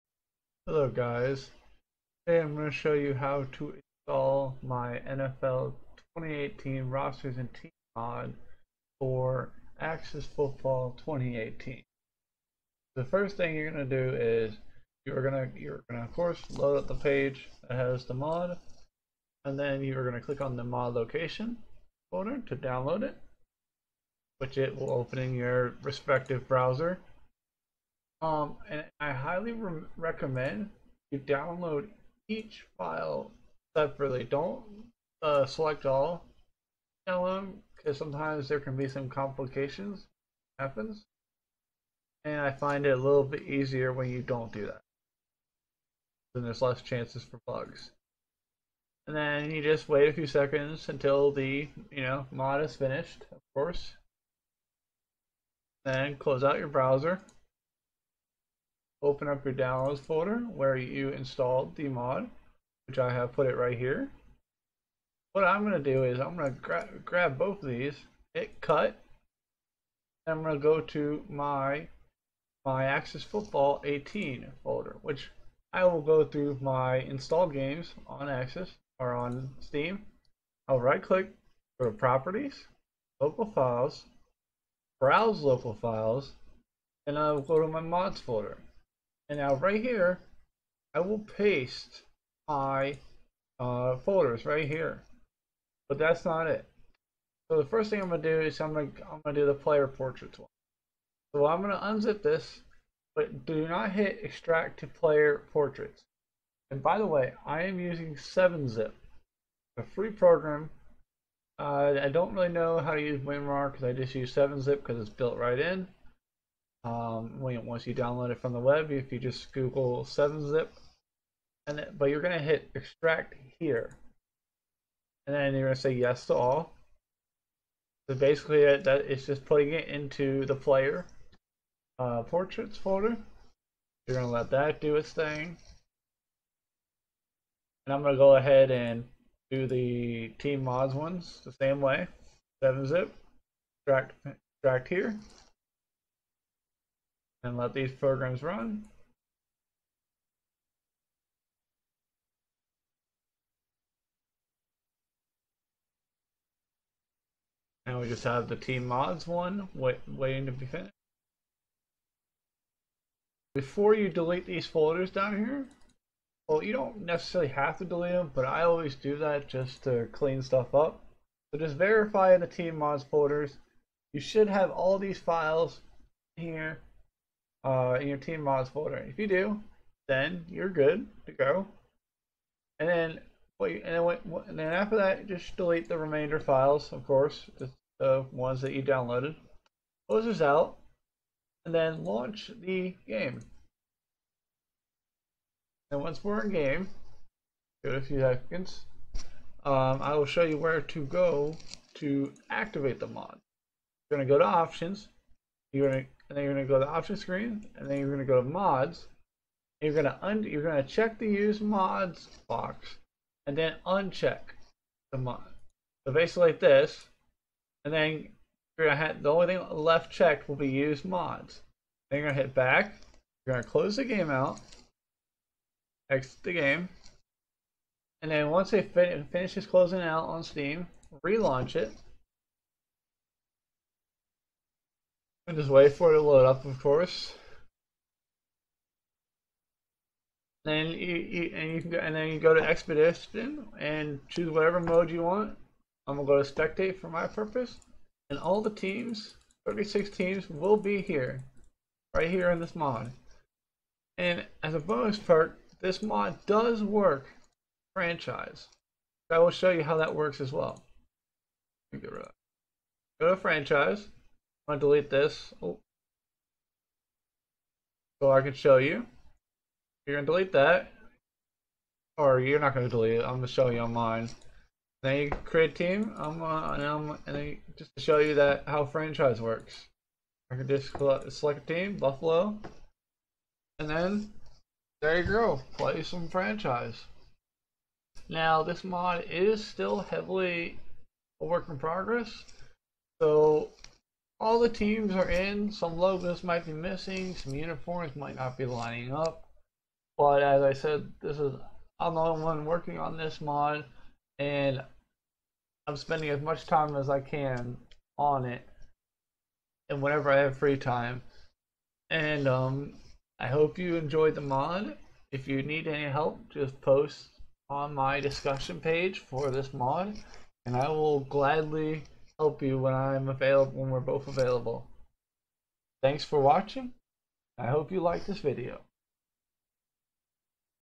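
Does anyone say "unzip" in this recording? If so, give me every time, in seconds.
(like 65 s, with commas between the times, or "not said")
101 s.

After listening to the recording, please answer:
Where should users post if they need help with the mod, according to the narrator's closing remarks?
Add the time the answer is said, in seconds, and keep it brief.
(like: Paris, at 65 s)
discussion page, at 318 s.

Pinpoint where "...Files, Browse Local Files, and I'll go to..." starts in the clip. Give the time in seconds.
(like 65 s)
83 s.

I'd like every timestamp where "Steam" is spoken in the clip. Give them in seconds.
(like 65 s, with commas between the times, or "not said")
79 s, 230 s.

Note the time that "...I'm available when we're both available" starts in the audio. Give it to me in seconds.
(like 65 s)
322 s.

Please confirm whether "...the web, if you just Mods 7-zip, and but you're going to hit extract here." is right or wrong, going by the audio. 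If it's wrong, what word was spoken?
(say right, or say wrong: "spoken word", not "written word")
wrong: "Google", not "Mods".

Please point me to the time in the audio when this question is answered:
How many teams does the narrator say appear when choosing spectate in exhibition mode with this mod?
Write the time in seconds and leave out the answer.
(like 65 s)
249 s.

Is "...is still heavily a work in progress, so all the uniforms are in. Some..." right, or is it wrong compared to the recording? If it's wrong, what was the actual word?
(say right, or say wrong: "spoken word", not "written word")
wrong: "teams", not "uniforms".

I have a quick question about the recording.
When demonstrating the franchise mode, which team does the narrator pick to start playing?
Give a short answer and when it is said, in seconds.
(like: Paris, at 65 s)
Buffalo, at 281 s.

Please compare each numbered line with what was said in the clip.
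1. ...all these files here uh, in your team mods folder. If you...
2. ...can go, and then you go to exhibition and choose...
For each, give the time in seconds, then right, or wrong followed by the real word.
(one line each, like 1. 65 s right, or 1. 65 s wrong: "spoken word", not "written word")
1. 174 s right
2. 241 s right.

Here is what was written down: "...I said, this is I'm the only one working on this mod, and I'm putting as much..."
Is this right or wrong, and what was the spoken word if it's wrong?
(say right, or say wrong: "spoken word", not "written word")
wrong: "spending", not "putting".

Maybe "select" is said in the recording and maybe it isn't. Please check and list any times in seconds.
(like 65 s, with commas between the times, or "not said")
35 s, 280 s.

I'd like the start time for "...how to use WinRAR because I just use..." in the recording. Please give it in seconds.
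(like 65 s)
112 s.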